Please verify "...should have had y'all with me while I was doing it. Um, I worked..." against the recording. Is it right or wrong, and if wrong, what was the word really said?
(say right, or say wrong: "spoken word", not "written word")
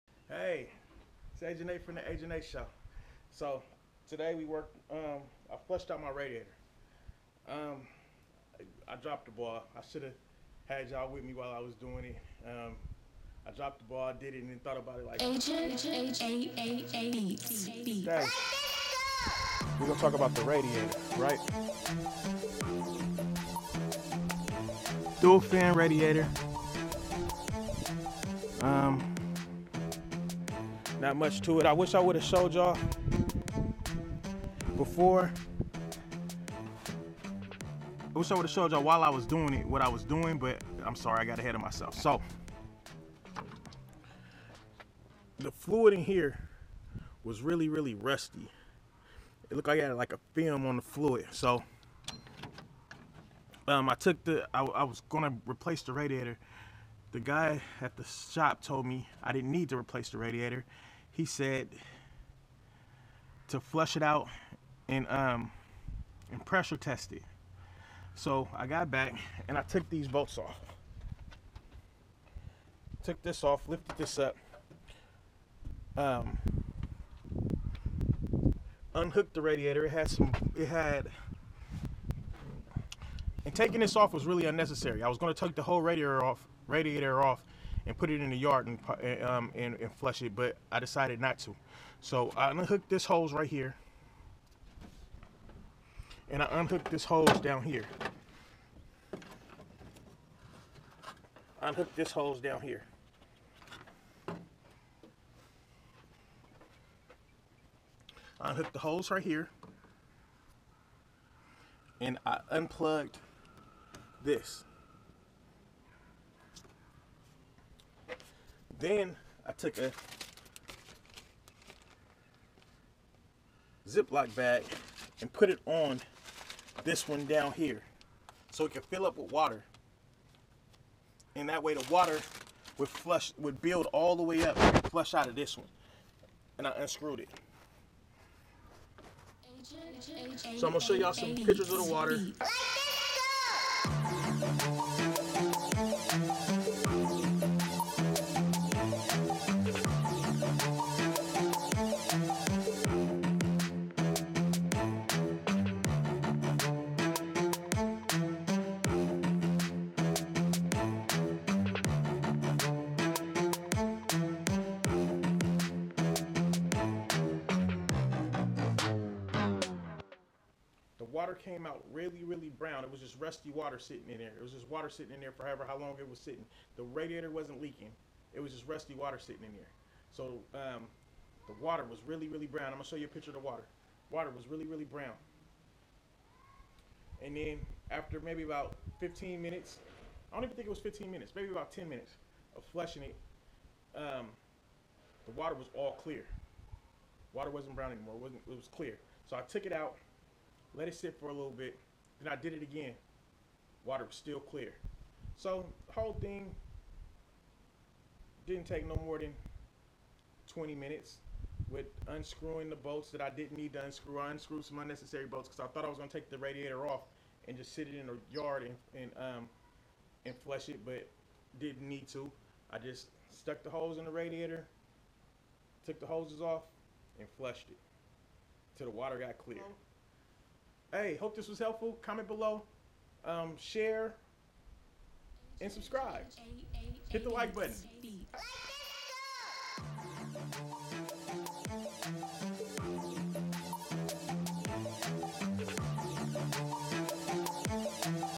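wrong: "dropped", not "worked".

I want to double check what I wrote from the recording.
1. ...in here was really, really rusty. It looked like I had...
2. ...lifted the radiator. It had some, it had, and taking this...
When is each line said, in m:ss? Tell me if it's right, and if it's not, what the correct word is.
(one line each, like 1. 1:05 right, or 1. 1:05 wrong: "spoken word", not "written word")
1. 0:45 right
2. 1:18 wrong: "unhooked", not "lifted".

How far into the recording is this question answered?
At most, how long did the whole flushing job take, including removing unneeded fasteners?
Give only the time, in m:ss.
3:30.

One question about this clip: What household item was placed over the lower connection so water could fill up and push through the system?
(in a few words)
Ziploc bag.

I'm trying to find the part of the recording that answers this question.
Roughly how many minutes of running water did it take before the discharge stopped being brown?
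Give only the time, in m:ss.
3:11.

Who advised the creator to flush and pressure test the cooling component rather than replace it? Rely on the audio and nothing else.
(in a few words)
The guy at the shop.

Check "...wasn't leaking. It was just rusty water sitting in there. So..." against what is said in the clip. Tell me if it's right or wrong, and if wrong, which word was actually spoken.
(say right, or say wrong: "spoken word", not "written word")
right.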